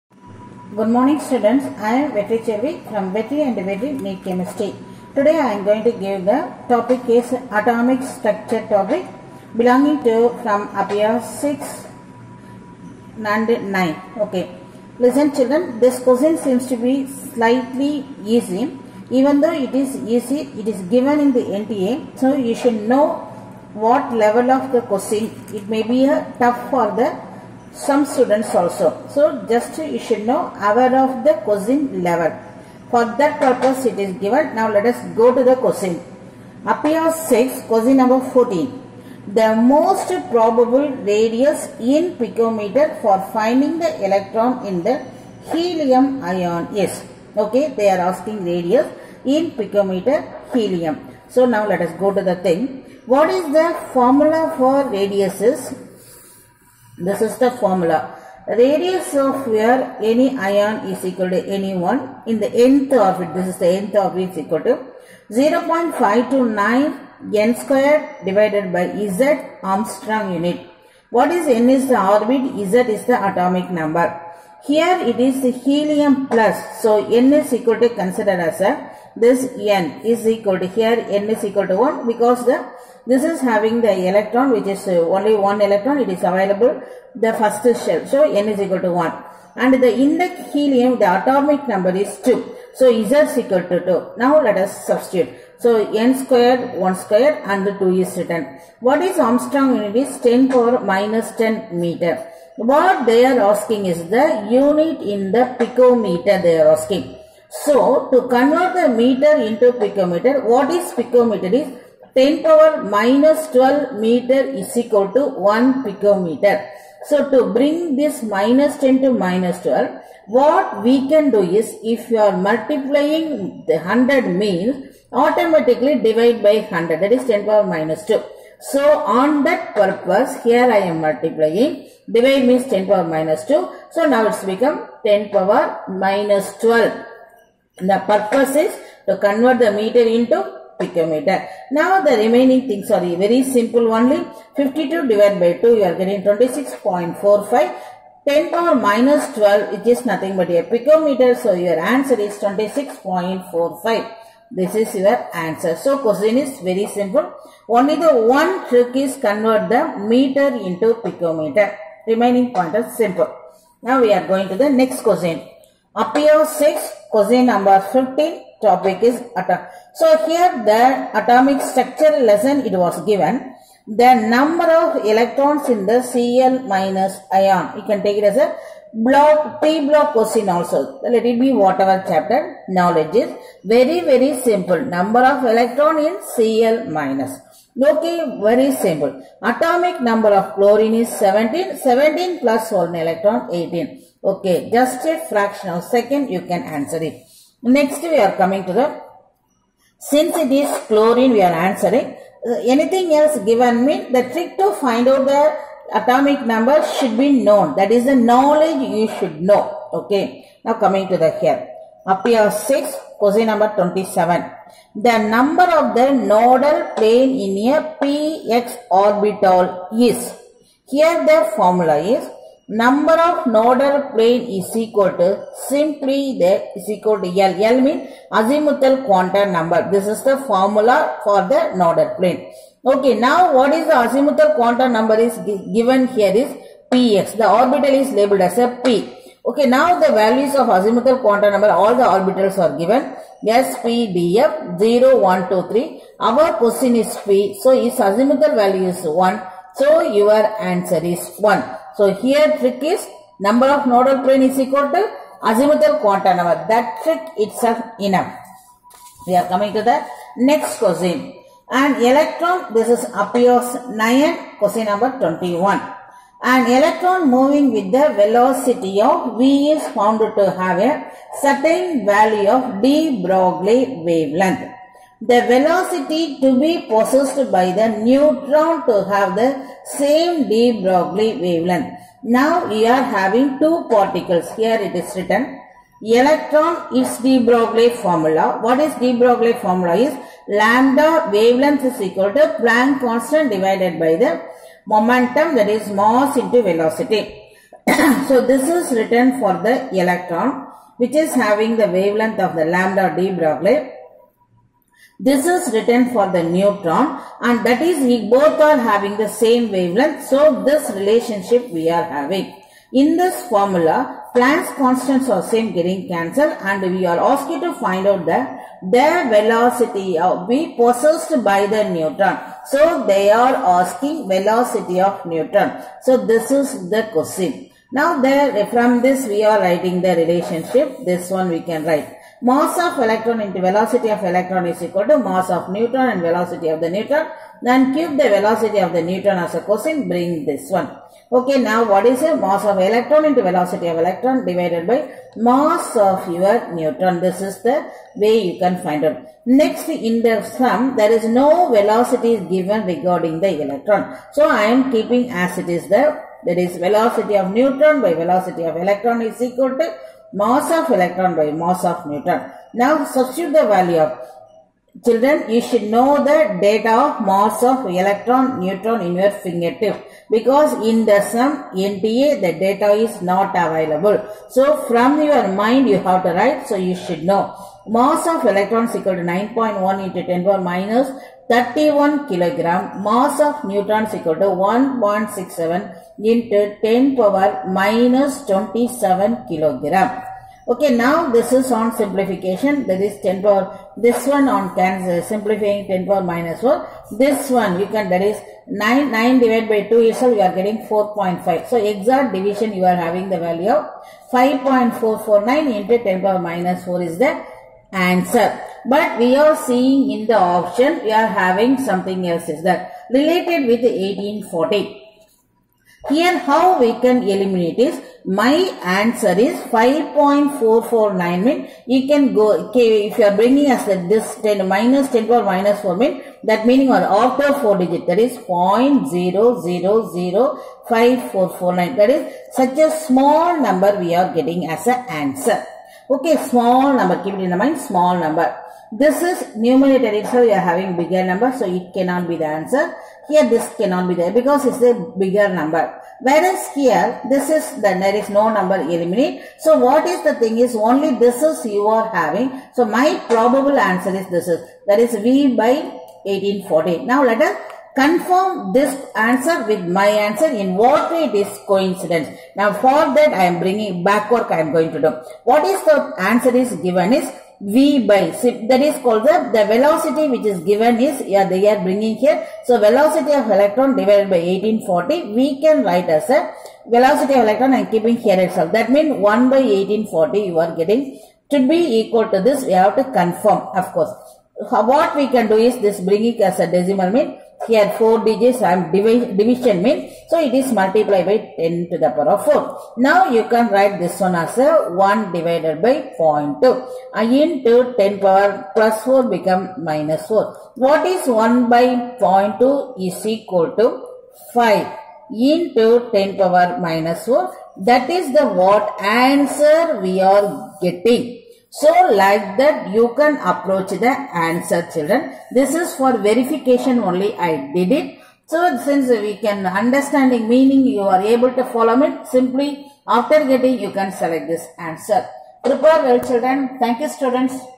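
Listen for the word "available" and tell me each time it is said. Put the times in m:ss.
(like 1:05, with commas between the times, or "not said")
1:26, 6:13.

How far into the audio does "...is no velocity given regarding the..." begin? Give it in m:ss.
5:51.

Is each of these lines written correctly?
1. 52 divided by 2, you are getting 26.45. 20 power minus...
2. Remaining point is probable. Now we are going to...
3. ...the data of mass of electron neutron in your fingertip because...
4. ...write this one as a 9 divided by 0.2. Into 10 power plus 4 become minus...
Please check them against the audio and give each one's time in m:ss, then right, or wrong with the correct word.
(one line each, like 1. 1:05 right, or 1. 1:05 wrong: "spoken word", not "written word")
1. 2:24 wrong: "10", not "20"
2. 2:42 wrong: "simple", not "probable"
3. 6:06 right
4. 8:13 wrong: "1", not "9".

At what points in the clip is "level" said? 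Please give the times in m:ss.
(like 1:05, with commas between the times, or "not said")
0:24, 0:32.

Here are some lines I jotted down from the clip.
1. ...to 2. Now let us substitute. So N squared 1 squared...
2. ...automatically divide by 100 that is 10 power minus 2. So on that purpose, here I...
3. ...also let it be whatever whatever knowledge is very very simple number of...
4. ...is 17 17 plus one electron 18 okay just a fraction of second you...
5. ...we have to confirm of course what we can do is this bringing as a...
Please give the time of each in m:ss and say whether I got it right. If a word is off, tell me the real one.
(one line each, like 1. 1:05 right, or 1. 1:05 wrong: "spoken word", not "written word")
1. 1:33 right
2. 2:05 right
3. 3:00 wrong: "chapter", not "whatever"
4. 3:10 right
5. 8:02 right.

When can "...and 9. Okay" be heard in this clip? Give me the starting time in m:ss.
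0:13.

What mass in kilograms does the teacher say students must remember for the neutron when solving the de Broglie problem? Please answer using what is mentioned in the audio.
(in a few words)
1.67 × 10^-27 kg.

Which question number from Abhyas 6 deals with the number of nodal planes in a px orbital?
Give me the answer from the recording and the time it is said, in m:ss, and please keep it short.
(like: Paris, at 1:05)
27, at 3:33.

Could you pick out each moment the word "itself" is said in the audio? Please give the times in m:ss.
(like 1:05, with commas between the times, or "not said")
4:17, 6:40, 7:58.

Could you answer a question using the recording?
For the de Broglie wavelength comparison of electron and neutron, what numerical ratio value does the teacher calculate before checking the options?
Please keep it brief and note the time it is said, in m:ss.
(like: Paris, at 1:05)
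5.449 × 10^-4, at 6:44.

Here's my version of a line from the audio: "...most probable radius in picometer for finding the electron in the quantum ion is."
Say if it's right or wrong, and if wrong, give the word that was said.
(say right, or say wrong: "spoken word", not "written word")
wrong: "helium", not "quantum".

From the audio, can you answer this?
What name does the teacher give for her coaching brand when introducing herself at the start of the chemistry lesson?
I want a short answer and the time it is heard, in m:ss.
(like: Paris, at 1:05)
Vetri and Vetri NEET Chemistry, at 0:03.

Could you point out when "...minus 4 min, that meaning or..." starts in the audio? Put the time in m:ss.
7:05.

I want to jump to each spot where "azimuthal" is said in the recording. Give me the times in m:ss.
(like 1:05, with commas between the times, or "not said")
3:48, 3:53, 4:00, 4:07, 4:15.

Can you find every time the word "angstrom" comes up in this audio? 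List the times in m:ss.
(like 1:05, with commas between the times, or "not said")
1:09, 1:39.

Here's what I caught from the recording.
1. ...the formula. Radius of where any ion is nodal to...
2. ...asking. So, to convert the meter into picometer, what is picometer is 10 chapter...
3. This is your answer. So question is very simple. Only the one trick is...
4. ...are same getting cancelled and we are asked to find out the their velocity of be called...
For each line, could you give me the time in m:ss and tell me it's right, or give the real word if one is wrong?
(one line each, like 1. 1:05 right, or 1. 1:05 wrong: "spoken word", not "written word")
1. 0:57 wrong: "equal", not "nodal"
2. 1:46 wrong: "power", not "chapter"
3. 2:34 right
4. 5:15 wrong: "possessed", not "called".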